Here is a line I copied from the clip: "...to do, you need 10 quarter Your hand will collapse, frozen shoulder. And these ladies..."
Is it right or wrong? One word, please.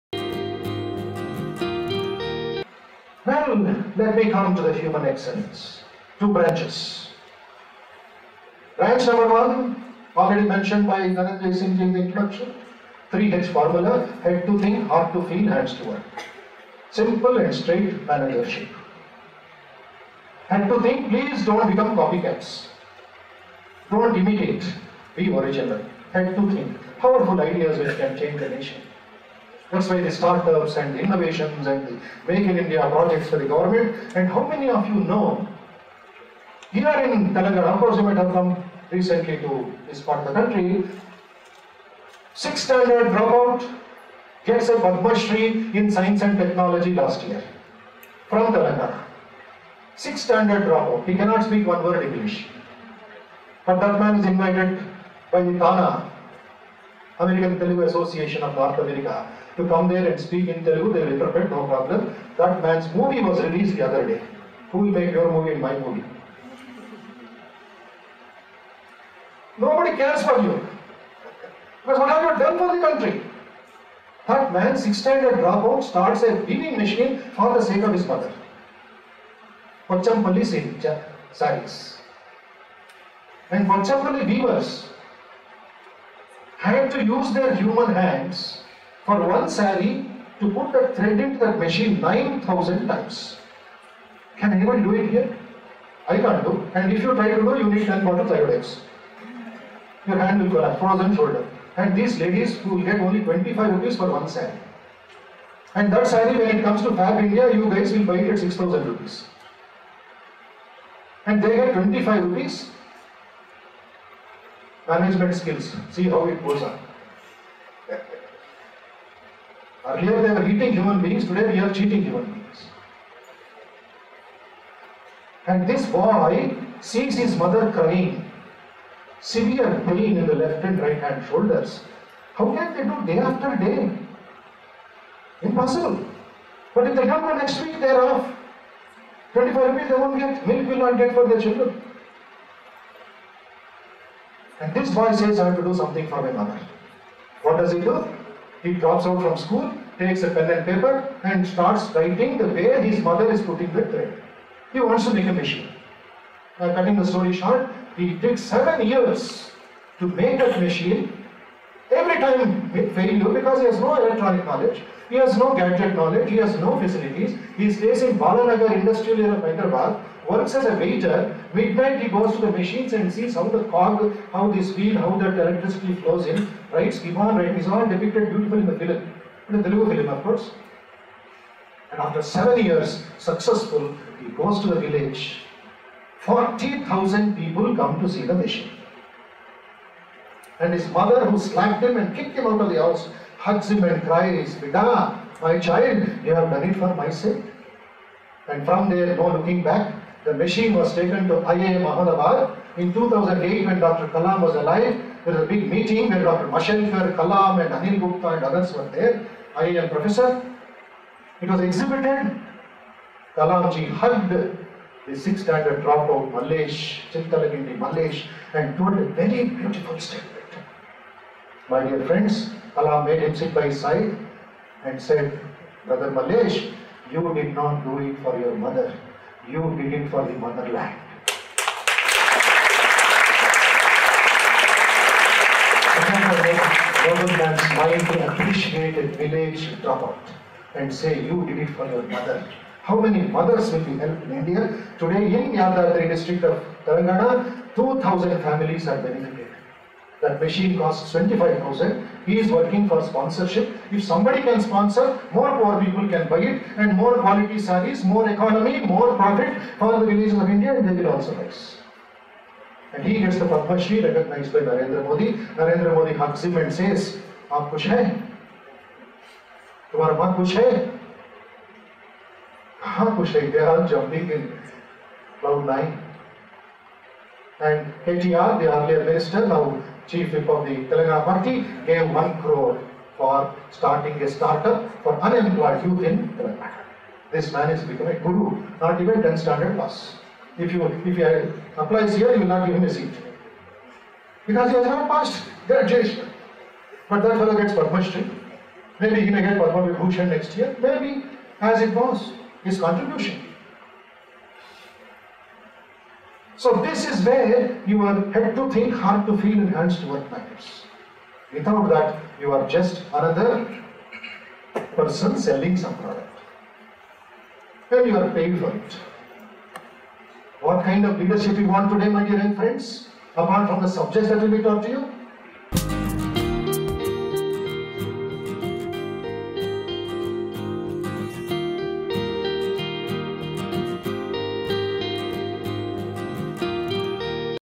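right.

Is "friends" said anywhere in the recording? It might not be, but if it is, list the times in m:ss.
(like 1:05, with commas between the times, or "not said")
3:42, 5:22.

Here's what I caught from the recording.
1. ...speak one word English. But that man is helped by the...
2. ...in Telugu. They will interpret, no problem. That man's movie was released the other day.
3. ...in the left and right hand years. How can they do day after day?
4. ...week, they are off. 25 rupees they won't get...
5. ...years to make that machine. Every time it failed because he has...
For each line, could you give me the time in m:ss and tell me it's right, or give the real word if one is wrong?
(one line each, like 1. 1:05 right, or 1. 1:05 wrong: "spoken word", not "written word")
1. 0:51 wrong: "invited", not "helped"
2. 1:00 right
3. 2:10 wrong: "shoulders", not "years"
4. 2:17 right
5. 2:38 right.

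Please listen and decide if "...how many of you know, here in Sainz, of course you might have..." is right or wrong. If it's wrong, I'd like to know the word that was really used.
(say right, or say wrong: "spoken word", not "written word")
wrong: "Telangana", not "Sainz".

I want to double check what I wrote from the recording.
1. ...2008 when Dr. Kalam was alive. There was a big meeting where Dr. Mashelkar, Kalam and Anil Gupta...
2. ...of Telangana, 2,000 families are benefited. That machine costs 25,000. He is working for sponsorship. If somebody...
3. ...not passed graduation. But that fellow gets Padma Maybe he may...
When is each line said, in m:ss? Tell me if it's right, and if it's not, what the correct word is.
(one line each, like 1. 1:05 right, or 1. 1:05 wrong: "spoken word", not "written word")
1. 3:22 right
2. 4:06 right
3. 4:54 right.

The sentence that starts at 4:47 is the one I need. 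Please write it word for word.
This man is becoming a guru, not even 10 standard pass.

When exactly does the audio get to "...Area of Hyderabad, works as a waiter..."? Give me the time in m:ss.
2:49.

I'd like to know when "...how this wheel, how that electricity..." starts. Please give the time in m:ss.
2:54.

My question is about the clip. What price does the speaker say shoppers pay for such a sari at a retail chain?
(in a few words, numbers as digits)
6,000 rupees.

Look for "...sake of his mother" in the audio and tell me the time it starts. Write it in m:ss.
1:17.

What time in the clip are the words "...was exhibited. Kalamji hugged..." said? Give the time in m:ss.
3:31.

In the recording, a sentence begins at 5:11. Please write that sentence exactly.
Without that, you are just another person selling some product.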